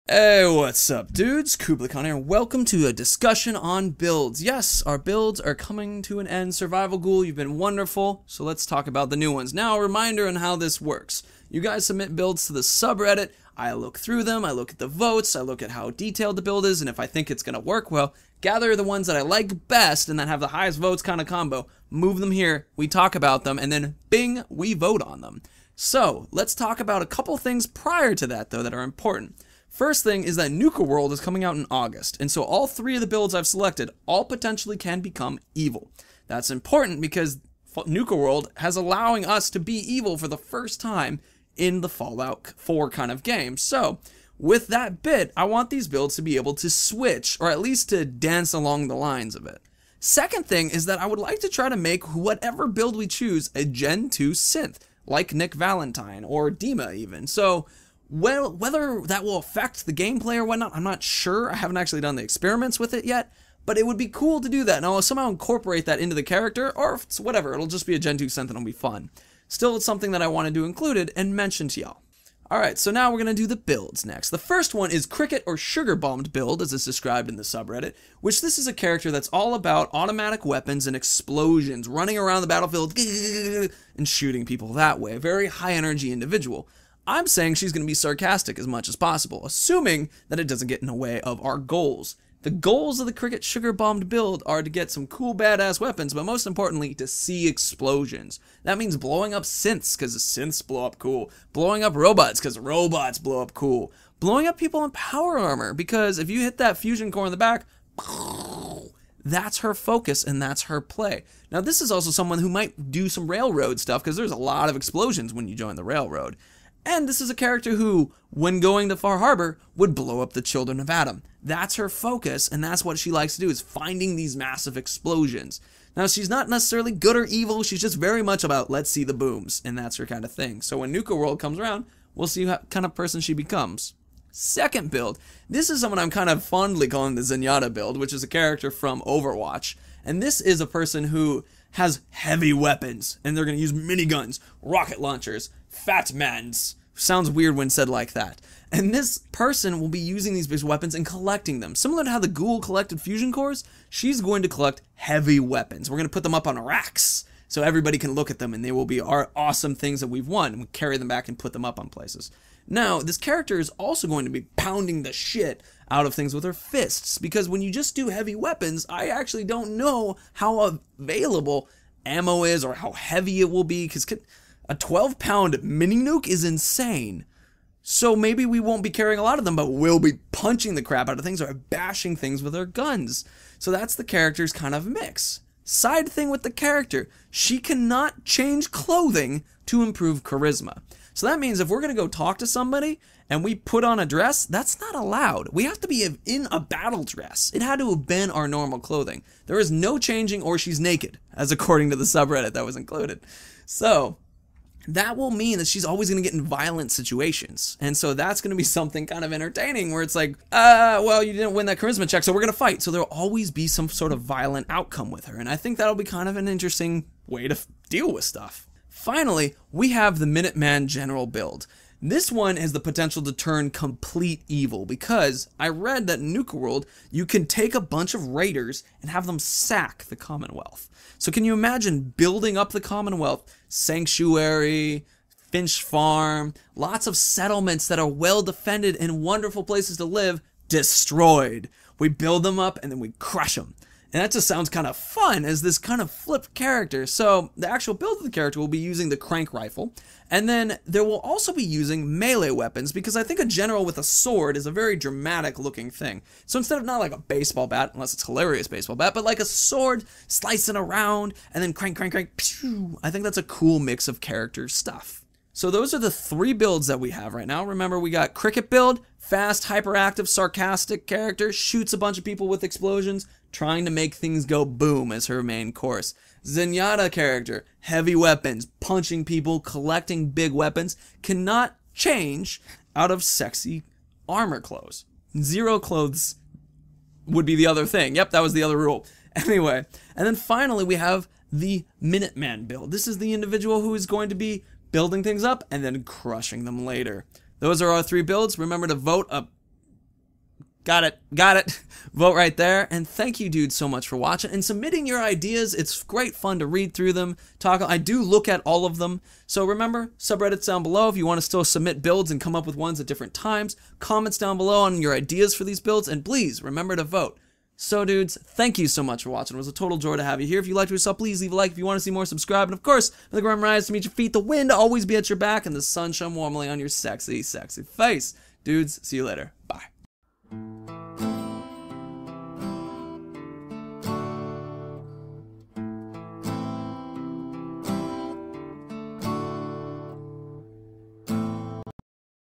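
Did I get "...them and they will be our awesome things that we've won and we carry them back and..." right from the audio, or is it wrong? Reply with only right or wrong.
right.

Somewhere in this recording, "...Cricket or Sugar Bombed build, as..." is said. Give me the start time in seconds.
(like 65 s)
75 s.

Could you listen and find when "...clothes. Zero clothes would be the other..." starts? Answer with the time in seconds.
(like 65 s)
284 s.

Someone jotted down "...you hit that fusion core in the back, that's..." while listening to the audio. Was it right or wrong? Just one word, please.
right.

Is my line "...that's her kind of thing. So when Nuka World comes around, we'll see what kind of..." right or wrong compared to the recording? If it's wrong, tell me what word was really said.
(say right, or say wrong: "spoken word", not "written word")
right.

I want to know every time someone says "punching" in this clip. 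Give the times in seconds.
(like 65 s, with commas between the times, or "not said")
180 s, 278 s.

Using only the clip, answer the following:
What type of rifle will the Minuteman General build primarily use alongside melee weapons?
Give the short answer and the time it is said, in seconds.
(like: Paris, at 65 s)
crank rifle, at 249 s.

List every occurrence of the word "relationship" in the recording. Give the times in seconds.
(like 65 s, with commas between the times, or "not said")
not said.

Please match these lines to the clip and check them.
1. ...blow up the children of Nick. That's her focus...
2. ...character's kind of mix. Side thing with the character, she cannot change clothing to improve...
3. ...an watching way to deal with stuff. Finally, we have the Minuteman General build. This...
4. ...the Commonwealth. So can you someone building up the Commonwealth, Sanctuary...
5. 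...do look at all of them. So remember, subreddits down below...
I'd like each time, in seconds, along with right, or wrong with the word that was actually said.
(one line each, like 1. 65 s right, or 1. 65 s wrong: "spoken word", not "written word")
1. 119 s wrong: "Atom", not "Nick"
2. 184 s right
3. 216 s wrong: "interesting", not "watching"
4. 230 s wrong: "imagine", not "someone"
5. 307 s right.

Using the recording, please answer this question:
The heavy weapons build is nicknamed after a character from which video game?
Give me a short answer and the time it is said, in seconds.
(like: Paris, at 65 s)
Overwatch, at 139 s.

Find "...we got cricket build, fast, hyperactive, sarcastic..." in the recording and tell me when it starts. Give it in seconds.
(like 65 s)
267 s.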